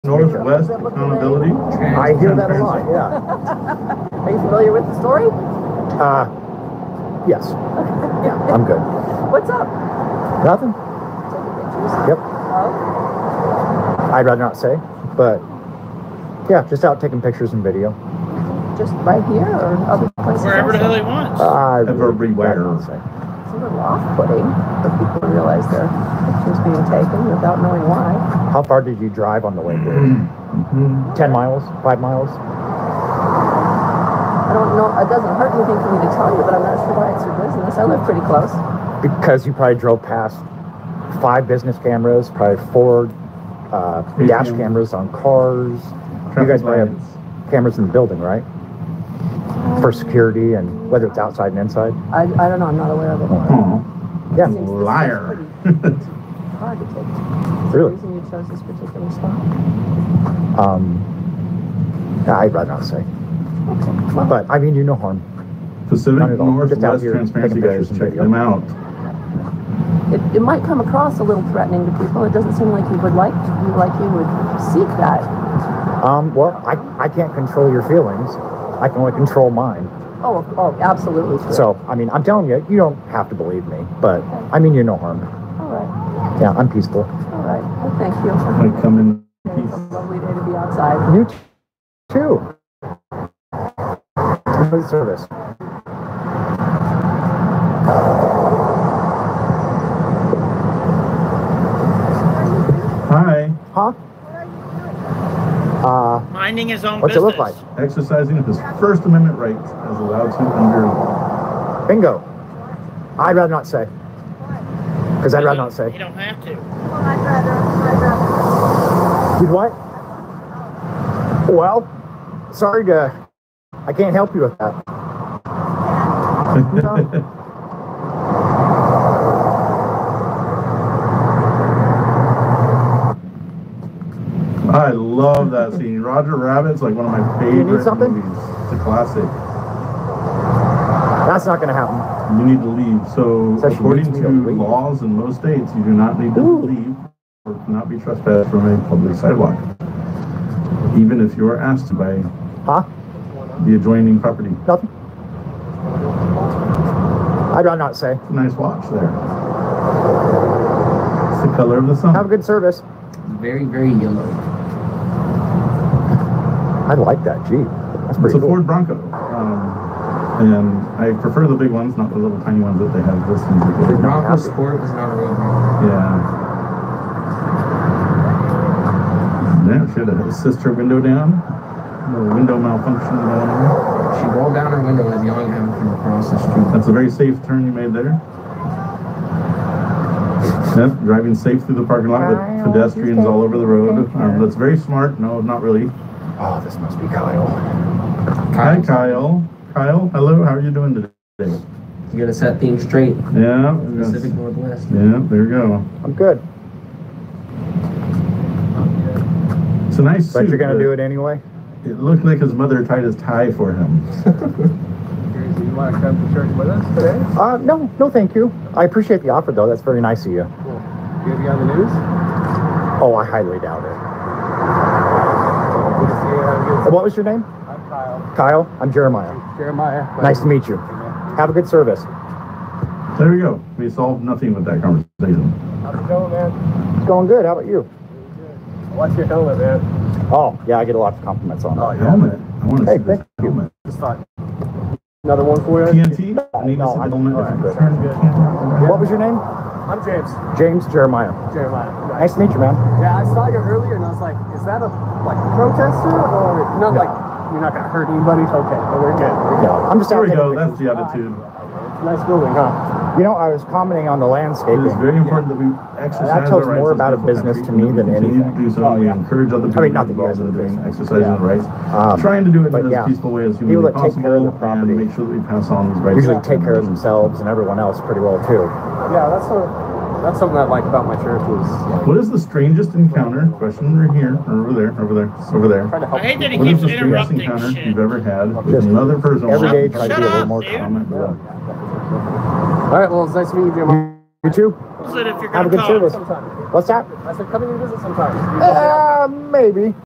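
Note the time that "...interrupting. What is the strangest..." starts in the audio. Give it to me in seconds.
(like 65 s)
286 s.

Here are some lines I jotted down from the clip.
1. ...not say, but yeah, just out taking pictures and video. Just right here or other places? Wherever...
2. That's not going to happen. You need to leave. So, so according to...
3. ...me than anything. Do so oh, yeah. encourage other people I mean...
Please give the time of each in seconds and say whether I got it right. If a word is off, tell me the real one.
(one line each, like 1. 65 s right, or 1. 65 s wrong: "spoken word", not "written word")
1. 14 s right
2. 141 s right
3. 267 s right.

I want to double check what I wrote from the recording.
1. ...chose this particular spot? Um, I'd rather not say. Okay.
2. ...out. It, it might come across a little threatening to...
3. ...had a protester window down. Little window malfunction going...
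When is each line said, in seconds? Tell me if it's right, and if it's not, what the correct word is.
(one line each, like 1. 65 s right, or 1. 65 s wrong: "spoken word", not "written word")
1. 58 s right
2. 68 s right
3. 179 s wrong: "sister", not "protester".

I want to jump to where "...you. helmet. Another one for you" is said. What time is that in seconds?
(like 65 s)
243 s.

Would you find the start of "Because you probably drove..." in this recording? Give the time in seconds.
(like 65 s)
39 s.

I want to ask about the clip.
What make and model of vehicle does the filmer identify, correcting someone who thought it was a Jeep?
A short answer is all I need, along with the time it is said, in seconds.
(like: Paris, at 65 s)
Ford Bronco, at 168 s.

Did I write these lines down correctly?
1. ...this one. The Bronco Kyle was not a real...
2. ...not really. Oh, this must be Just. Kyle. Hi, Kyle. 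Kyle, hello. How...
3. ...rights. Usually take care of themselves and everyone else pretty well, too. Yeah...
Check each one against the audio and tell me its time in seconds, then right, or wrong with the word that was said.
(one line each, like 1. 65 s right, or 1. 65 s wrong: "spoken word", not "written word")
1. 173 s wrong: "Sport", not "Kyle"
2. 195 s wrong: "Kyle", not "Just"
3. 276 s right.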